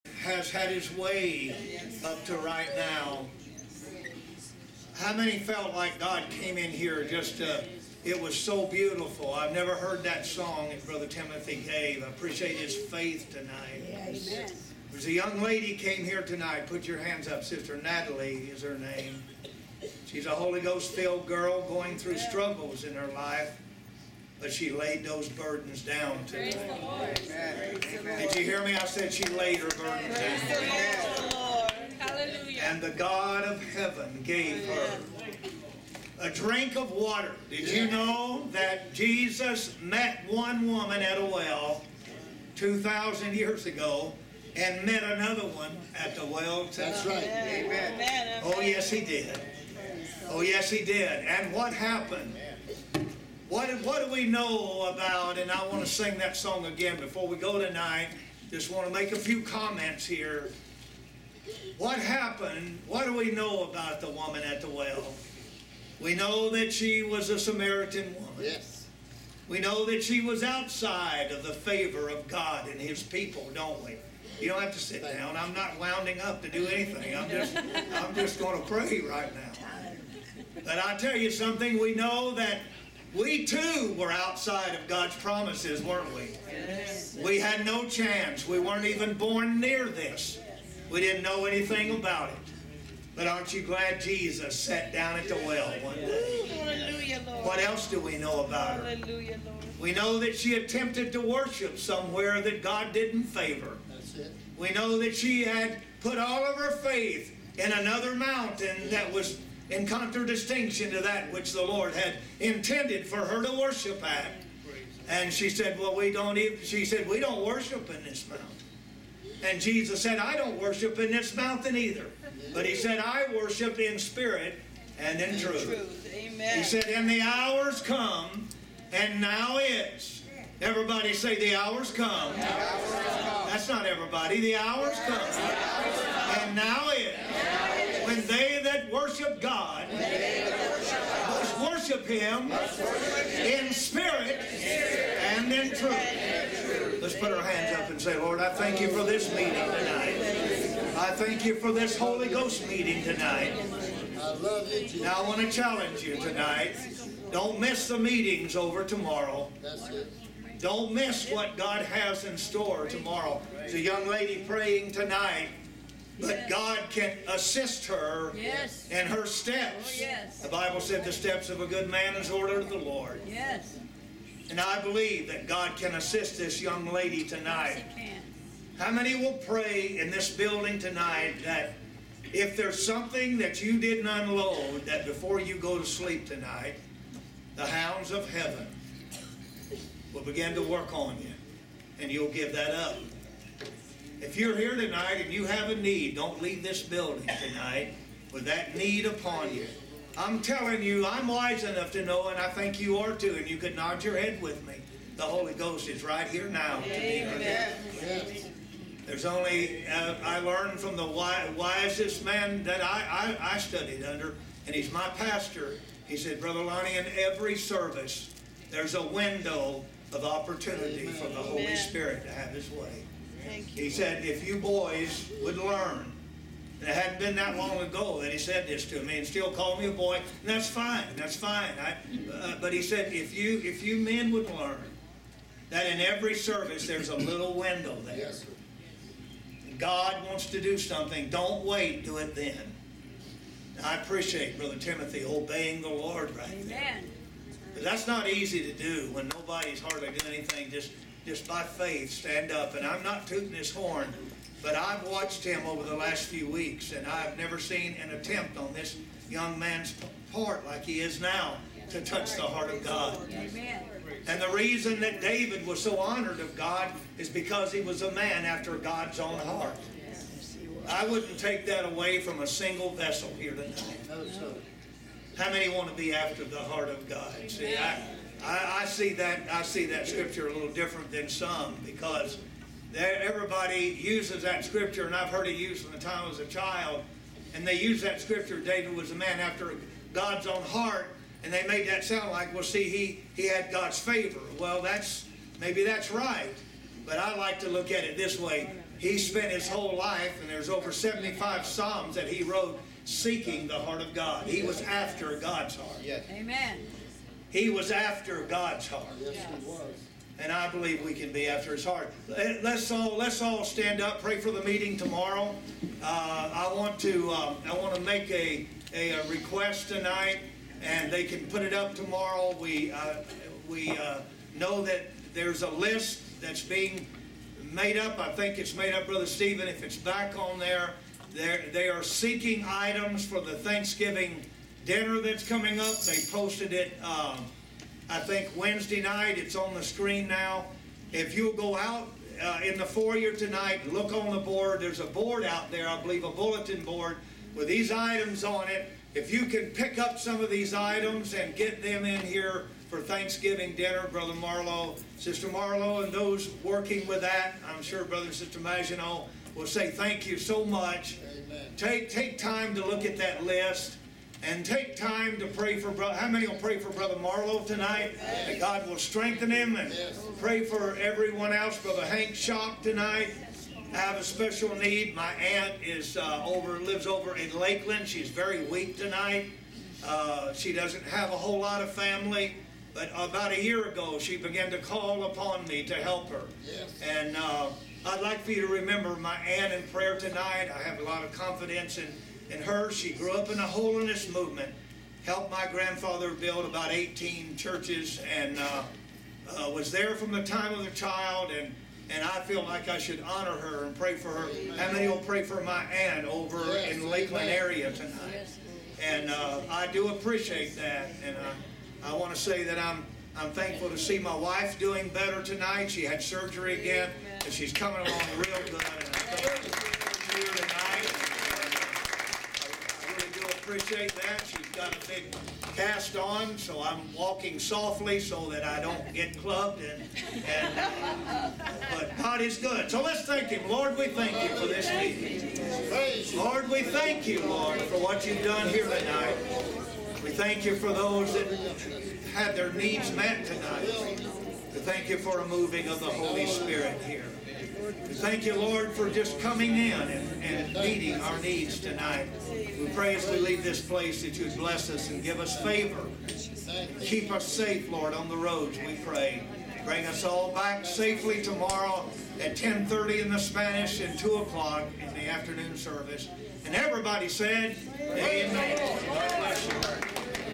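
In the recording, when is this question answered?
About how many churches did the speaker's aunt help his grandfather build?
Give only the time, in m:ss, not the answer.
6:36.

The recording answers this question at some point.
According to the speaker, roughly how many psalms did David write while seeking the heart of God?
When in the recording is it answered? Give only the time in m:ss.
5:00.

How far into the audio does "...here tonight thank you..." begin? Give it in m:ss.
7:18.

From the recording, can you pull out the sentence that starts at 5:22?
We uh, we uh, know that there's a list that's being made up.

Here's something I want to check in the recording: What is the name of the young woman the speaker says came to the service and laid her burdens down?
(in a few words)
Natalie.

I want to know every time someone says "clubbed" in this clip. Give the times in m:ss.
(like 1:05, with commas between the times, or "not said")
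7:09.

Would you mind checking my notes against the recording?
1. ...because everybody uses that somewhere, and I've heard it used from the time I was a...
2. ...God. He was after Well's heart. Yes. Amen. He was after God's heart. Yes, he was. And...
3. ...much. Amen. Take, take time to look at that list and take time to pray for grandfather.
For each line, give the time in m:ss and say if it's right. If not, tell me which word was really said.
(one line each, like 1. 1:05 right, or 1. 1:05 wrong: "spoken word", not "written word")
1. 4:41 wrong: "scripture", not "somewhere"
2. 5:04 wrong: "God", not "Well"
3. 6:00 wrong: "brother", not "grandfather".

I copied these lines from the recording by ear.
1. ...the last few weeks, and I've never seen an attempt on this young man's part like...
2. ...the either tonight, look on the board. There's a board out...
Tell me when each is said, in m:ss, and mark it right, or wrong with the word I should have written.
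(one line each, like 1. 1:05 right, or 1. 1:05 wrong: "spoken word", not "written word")
1. 4:15 right
2. 5:42 wrong: "foyer", not "either".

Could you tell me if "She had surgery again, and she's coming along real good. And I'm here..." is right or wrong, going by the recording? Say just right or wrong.
right.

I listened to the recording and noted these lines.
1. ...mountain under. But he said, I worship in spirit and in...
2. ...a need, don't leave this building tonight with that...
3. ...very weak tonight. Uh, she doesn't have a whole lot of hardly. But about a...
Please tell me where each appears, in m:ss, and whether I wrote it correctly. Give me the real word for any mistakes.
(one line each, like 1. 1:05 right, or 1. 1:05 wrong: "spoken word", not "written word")
1. 2:01 wrong: "either", not "under"
2. 3:15 right
3. 6:18 wrong: "family", not "hardly".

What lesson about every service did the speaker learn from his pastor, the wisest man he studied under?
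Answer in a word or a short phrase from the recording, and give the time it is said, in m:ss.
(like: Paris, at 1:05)
window of opportunity, at 3:39.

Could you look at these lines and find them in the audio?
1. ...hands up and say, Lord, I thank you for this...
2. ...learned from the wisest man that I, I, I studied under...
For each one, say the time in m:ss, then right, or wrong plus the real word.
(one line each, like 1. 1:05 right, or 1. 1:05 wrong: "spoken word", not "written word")
1. 2:27 right
2. 3:30 right.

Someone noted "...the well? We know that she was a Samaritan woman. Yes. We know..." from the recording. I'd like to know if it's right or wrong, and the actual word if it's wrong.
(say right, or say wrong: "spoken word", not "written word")
right.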